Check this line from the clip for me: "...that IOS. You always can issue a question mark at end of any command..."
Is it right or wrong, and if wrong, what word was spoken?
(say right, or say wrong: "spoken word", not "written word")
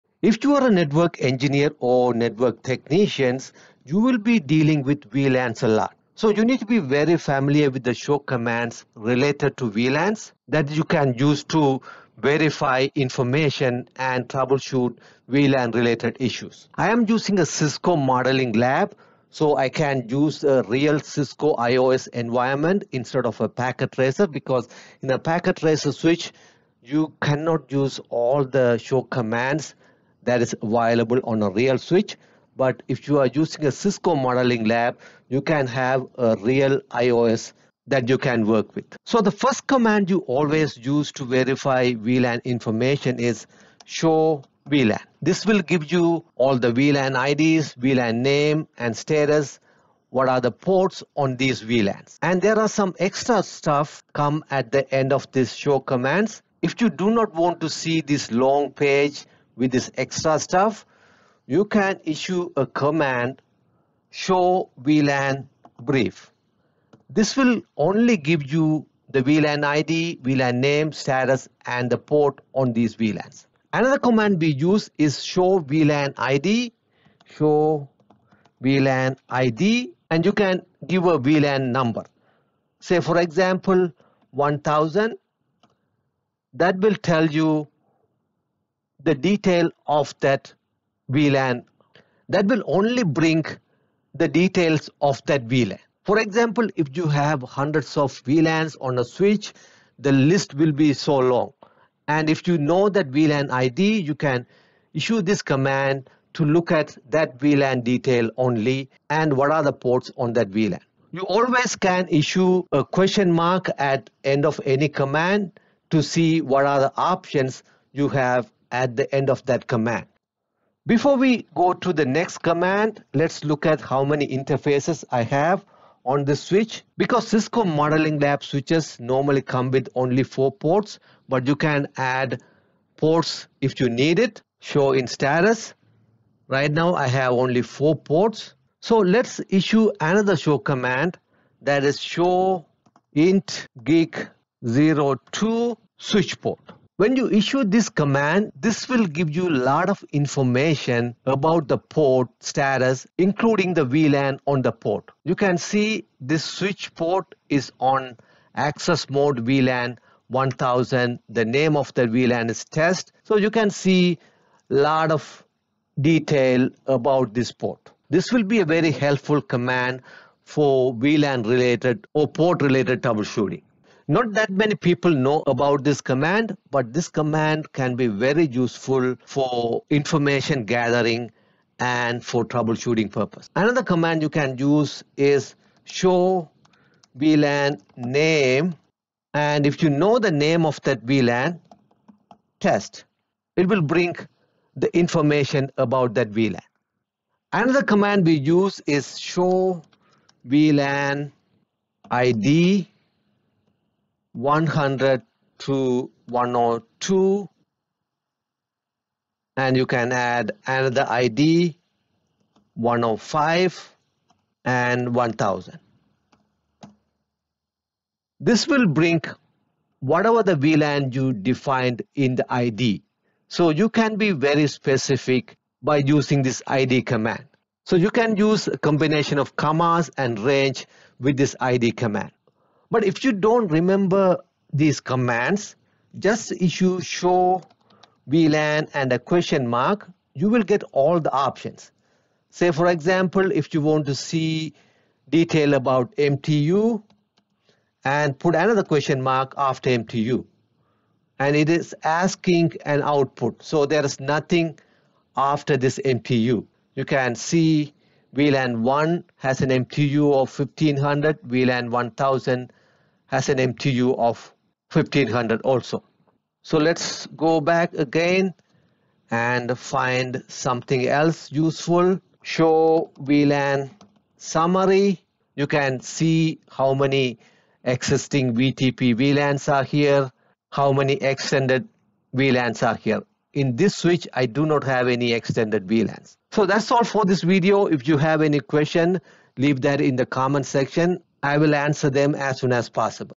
wrong: "VLAN", not "IOS".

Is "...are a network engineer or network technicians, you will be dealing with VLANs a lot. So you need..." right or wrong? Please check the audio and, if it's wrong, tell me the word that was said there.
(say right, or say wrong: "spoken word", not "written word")
right.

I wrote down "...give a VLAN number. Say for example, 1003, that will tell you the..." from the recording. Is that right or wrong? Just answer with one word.
wrong.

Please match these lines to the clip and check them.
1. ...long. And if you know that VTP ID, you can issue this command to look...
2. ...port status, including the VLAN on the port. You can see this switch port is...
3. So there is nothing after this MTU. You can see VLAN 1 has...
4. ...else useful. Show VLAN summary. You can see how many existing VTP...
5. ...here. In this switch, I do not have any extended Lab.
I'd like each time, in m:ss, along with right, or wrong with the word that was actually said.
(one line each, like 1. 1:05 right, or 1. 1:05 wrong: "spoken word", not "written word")
1. 1:41 wrong: "VLAN", not "VTP"
2. 2:31 right
3. 4:13 right
4. 4:31 right
5. 4:42 wrong: "VLANs", not "Lab".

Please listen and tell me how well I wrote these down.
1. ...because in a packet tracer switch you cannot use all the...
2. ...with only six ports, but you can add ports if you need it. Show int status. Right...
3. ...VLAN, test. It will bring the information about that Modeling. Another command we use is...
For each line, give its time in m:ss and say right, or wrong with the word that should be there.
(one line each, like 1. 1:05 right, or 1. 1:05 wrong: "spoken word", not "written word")
1. 0:24 right
2. 2:09 wrong: "four", not "six"
3. 3:11 wrong: "VLAN", not "Modeling".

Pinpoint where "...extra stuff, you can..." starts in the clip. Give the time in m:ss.
0:59.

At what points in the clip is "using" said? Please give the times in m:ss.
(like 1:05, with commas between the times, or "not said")
0:17, 0:33, 3:45.